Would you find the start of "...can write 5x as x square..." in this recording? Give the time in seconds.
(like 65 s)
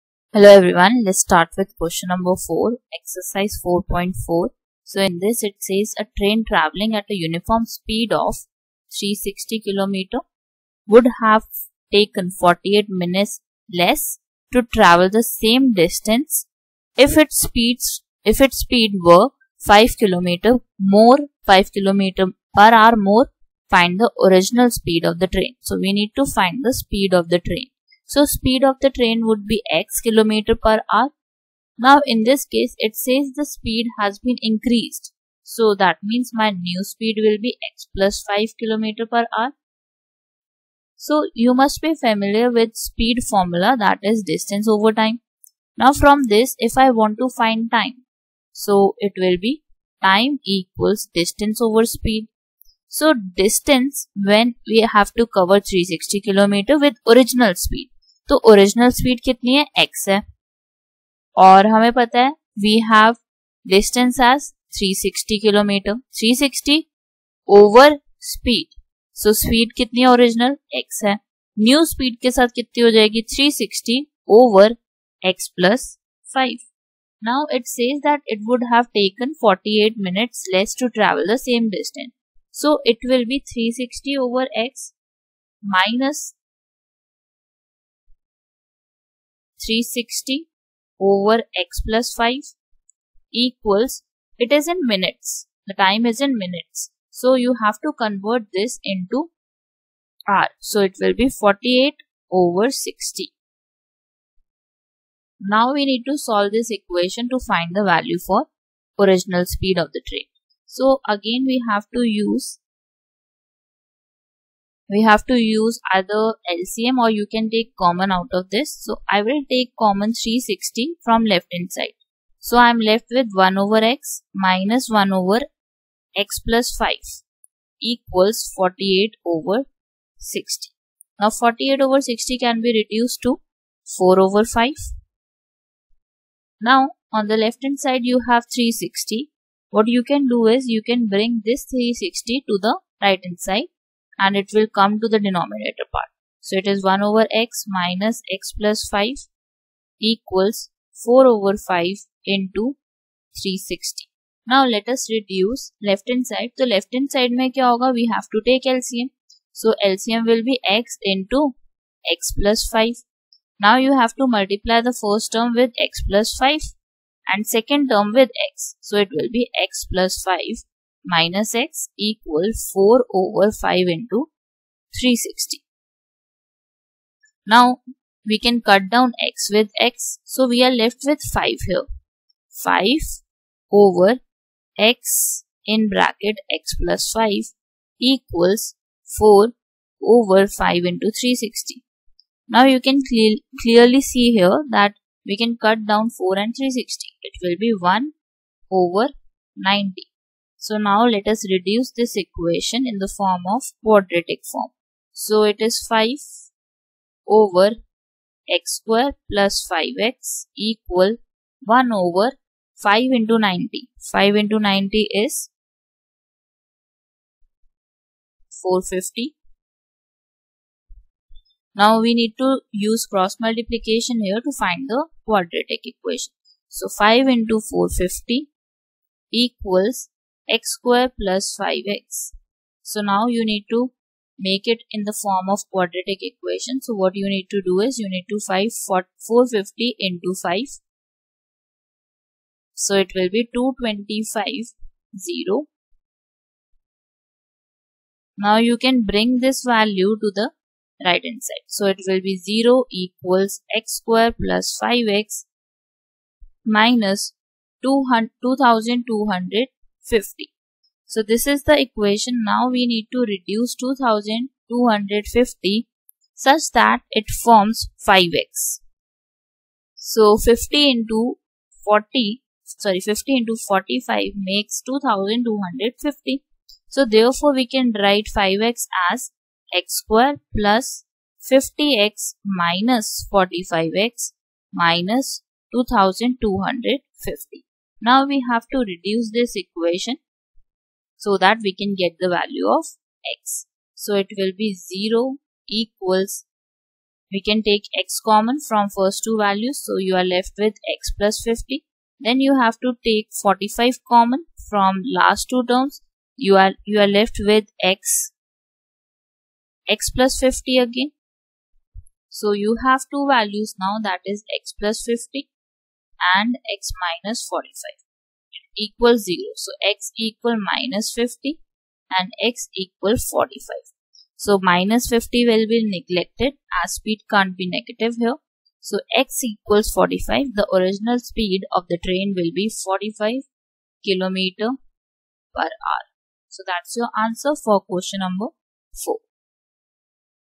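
277 s.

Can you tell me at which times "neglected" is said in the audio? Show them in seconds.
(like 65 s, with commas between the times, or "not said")
325 s.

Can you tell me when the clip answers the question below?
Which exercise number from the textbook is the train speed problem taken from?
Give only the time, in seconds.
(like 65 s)
2 s.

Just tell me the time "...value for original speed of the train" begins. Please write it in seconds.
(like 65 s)
107 s.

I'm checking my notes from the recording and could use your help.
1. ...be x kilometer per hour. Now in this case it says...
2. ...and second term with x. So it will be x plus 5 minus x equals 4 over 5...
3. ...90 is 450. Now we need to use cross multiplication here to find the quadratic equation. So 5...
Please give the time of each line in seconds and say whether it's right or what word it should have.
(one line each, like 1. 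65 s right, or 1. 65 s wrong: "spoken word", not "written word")
1. 29 s right
2. 167 s right
3. 214 s right.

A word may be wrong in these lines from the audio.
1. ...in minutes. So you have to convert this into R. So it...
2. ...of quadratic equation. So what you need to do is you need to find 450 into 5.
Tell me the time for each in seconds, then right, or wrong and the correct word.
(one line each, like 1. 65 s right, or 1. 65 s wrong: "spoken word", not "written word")
1. 96 s right
2. 235 s right.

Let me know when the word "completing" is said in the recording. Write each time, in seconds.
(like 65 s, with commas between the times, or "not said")
not said.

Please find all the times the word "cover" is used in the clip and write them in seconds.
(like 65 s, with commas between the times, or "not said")
55 s.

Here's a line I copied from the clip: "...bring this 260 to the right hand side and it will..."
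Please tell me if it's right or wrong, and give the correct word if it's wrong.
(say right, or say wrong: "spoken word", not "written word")
wrong: "360", not "260".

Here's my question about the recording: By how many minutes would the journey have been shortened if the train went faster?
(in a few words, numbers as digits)
48 minutes.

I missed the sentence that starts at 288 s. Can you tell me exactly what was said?
Now we have to reduce this equation so that we can get the value of x.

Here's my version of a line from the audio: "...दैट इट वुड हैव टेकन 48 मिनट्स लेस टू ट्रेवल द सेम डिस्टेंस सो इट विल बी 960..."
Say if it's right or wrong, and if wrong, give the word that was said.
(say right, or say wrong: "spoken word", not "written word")
wrong: "360", not "960".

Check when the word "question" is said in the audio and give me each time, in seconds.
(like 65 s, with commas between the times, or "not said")
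1 s, 337 s.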